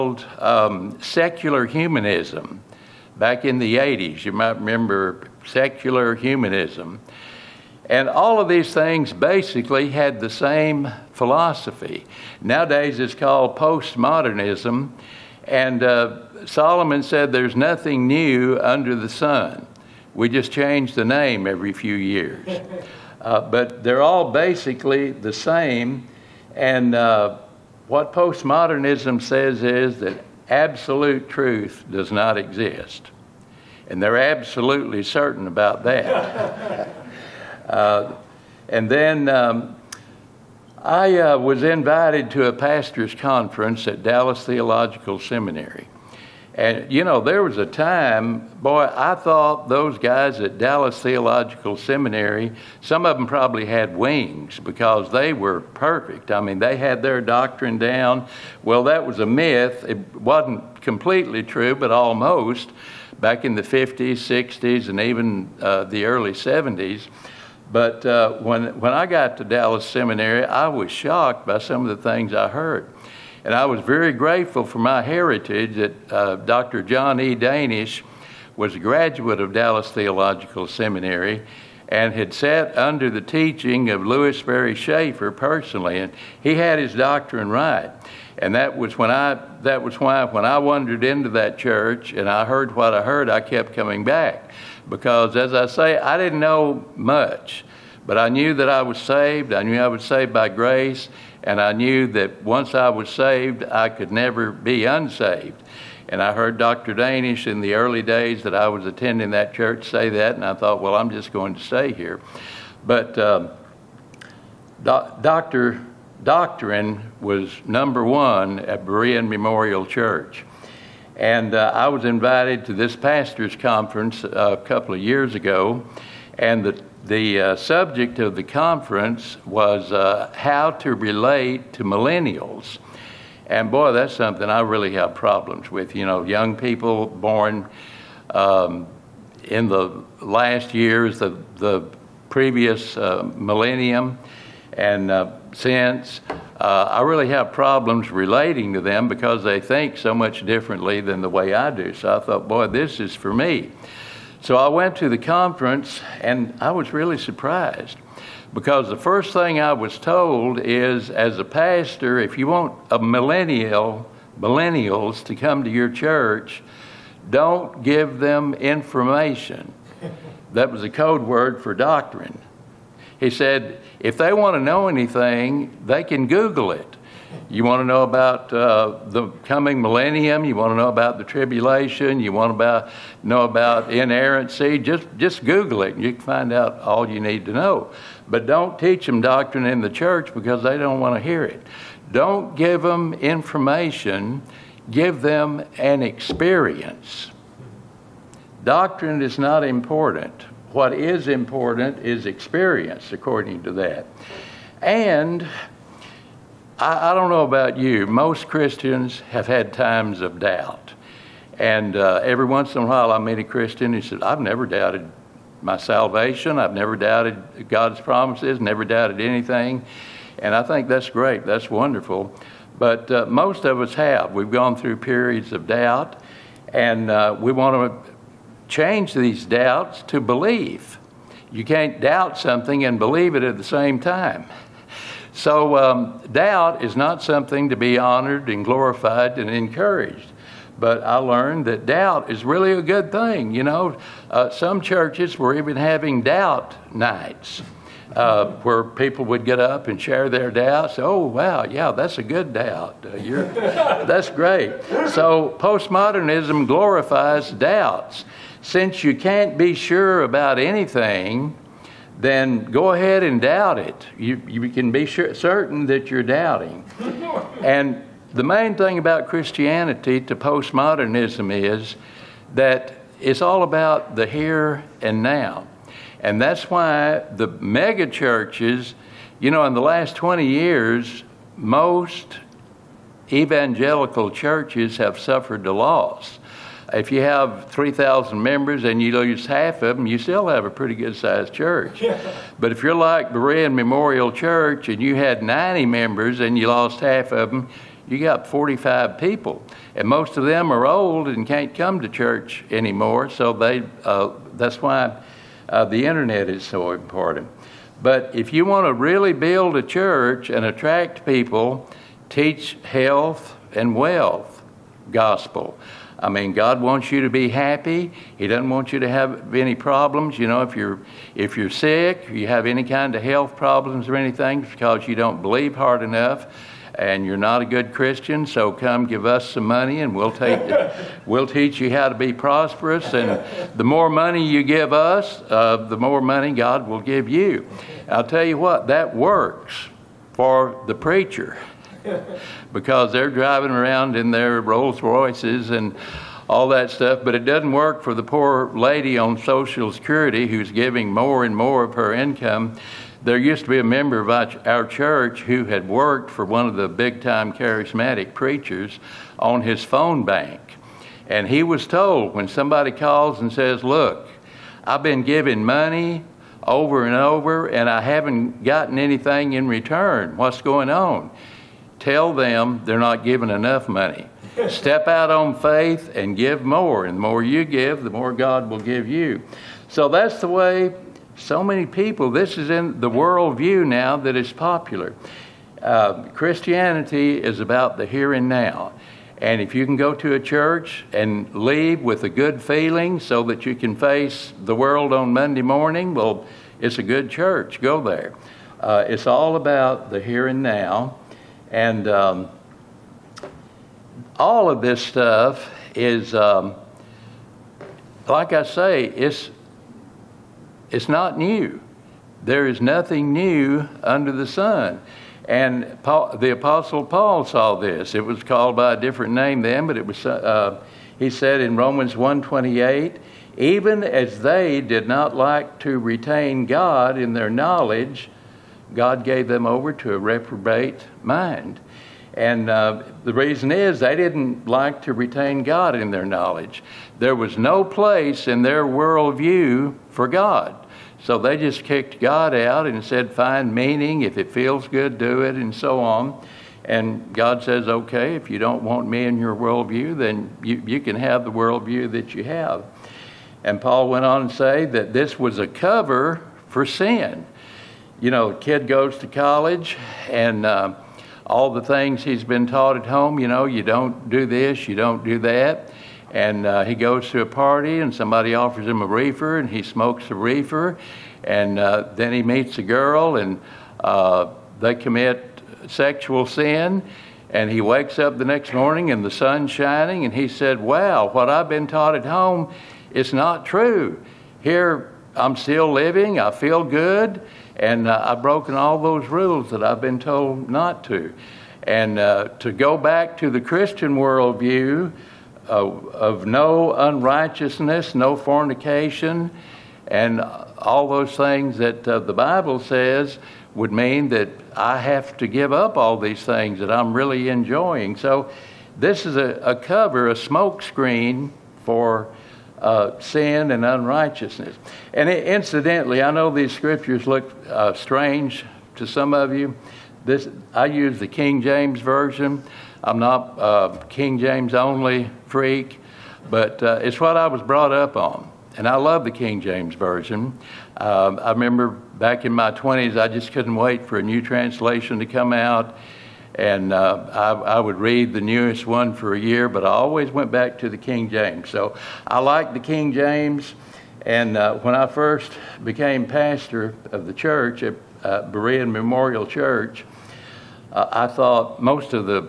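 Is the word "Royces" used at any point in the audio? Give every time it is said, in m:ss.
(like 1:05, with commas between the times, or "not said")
5:45.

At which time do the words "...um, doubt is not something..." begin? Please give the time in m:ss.
3:55.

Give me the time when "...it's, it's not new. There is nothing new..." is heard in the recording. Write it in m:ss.
6:49.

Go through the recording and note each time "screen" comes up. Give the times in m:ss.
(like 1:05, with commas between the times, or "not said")
8:30.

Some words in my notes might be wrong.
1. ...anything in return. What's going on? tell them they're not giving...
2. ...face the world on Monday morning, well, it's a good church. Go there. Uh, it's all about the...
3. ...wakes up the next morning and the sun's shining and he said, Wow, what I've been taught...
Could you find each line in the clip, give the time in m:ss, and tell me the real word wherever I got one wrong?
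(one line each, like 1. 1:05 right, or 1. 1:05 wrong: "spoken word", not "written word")
1. 6:08 right
2. 6:33 right
3. 7:57 right.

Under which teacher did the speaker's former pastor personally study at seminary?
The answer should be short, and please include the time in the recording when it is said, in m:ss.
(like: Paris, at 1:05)
Lewis Sperry Chafer, at 1:24.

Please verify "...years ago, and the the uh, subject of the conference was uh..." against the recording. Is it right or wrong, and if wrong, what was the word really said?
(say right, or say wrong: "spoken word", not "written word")
right.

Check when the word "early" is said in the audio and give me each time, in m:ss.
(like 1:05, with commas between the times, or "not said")
1:06, 1:47.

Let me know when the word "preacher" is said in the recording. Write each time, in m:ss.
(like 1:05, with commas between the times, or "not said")
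5:40, 5:58.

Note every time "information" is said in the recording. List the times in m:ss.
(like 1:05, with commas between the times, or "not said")
2:48, 3:13.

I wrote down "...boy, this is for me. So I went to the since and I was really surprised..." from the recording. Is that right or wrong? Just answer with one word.
wrong.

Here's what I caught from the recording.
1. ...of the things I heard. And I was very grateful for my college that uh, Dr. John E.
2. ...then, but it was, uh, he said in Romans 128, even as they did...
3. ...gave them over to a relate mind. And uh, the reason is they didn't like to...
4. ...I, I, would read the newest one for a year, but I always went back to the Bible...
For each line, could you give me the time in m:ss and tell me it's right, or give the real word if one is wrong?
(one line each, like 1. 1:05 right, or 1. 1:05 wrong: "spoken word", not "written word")
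1. 1:11 wrong: "heritage", not "college"
2. 6:59 right
3. 7:09 wrong: "reprobate", not "relate"
4. 8:57 wrong: "King", not "Bible".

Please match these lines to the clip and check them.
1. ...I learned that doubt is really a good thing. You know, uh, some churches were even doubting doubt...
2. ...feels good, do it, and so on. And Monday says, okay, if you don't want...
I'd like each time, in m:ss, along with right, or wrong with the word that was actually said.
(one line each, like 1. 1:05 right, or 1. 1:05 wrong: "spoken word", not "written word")
1. 4:01 wrong: "having", not "doubting"
2. 7:24 wrong: "God", not "Monday".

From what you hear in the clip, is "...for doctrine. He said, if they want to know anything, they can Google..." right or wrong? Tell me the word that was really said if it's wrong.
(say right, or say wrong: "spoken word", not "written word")
right.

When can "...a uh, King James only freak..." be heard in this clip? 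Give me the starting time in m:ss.
8:43.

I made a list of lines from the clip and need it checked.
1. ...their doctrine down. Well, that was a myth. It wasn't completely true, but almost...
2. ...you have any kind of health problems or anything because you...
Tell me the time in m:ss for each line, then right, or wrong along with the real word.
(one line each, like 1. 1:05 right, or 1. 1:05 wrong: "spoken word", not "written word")
1. 0:57 right
2. 5:22 right.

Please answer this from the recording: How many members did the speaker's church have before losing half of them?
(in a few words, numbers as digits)
90.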